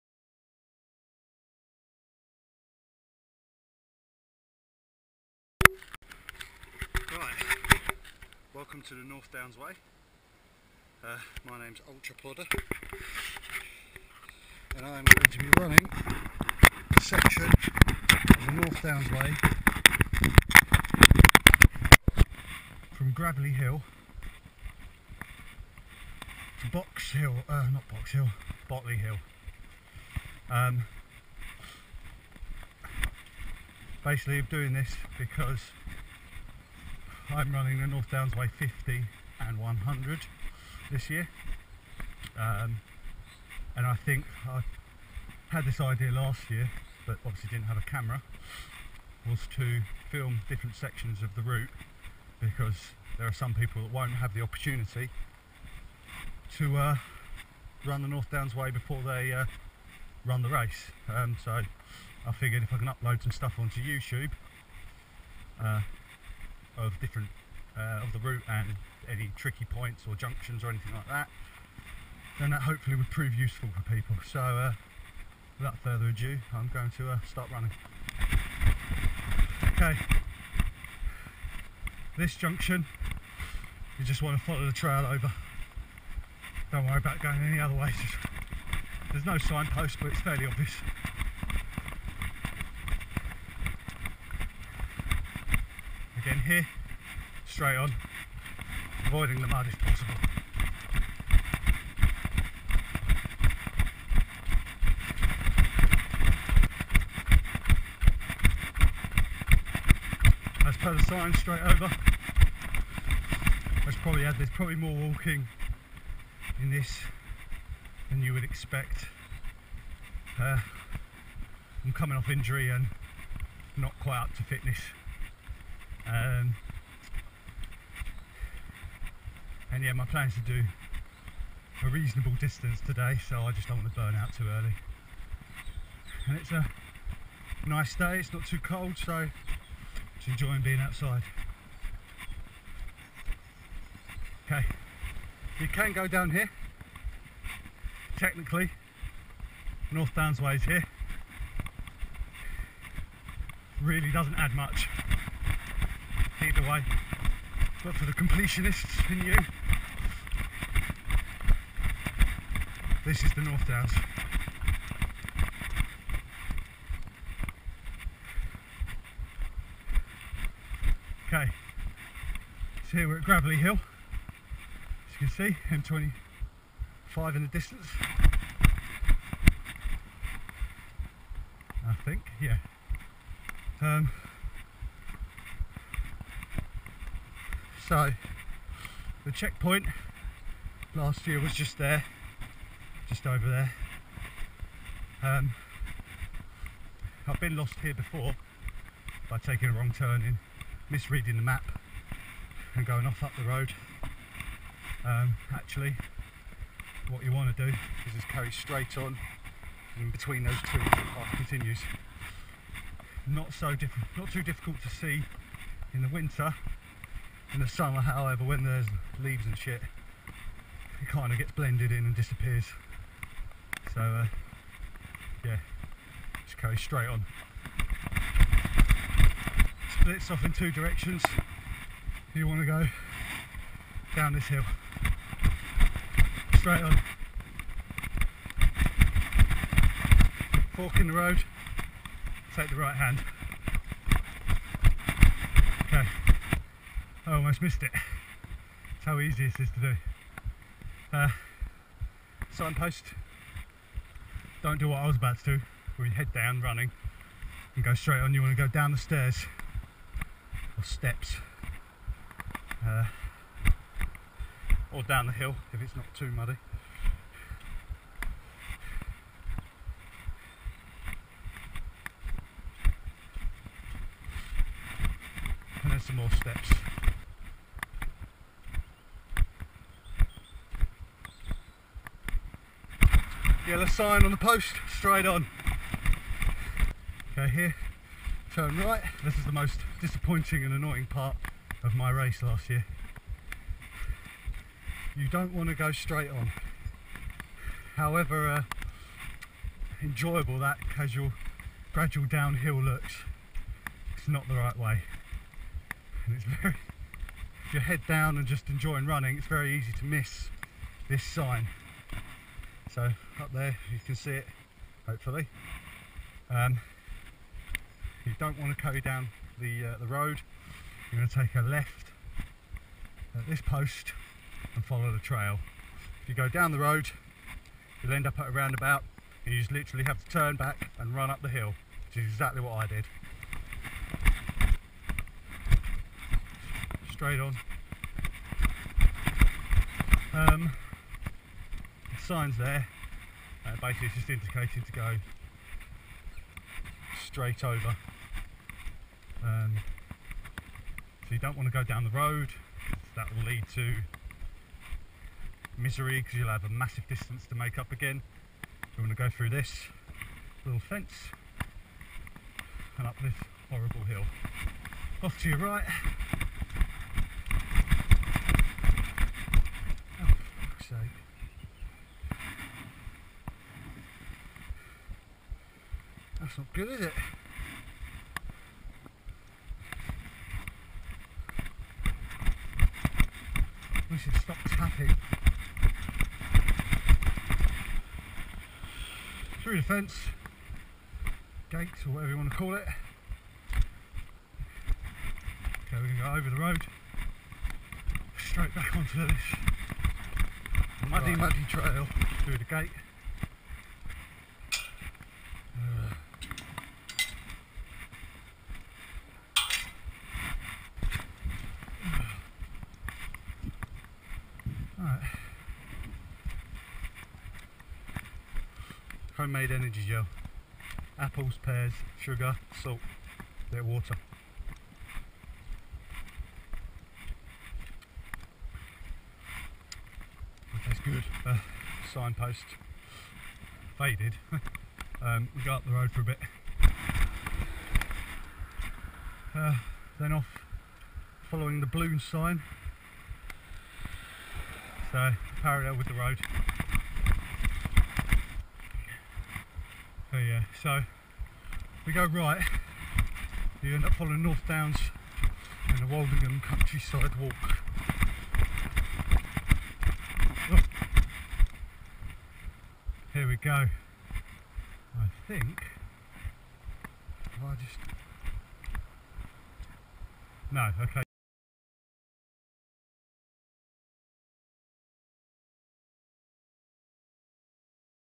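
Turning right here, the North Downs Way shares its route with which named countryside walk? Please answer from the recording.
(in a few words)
Woldingham Countryside Walk.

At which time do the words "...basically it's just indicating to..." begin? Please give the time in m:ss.
5:43.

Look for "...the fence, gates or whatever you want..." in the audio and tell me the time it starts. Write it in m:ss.
6:29.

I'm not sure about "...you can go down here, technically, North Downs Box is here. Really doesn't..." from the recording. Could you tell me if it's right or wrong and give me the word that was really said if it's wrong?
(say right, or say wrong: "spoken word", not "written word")
wrong: "Way", not "Box".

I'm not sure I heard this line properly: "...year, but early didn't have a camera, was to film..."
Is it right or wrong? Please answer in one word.
wrong.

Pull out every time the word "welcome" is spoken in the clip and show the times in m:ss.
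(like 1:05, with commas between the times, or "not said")
0:08.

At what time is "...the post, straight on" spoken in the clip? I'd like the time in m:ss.
4:44.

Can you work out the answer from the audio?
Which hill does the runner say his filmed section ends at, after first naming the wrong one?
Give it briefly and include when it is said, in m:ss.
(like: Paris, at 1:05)
Botley Hill, at 0:28.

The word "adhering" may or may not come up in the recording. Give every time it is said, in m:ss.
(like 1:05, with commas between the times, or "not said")
not said.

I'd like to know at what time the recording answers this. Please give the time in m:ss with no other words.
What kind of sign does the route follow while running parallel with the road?
7:21.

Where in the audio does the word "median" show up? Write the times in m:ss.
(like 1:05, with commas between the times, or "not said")
not said.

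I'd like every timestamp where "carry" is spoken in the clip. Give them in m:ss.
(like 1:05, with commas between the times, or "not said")
3:28, 3:46, 5:18.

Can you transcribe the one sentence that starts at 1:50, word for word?
As per the sign, straight over.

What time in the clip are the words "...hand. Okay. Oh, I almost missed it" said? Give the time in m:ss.
4:02.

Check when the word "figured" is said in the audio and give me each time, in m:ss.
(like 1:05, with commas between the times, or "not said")
1:02.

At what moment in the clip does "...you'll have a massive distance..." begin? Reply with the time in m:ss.
5:56.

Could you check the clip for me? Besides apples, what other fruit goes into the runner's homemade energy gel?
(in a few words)
Pears.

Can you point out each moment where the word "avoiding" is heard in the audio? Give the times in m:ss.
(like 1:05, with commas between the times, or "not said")
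1:39.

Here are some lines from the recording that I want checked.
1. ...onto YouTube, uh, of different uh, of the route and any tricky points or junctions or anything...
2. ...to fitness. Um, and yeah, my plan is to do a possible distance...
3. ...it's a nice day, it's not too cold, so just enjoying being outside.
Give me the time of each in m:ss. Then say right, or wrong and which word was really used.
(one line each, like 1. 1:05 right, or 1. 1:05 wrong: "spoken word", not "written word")
1. 1:03 right
2. 2:04 wrong: "reasonable", not "possible"
3. 2:16 right.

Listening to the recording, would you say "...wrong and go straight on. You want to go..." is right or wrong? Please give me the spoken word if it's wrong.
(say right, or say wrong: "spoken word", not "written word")
wrong: "running", not "wrong".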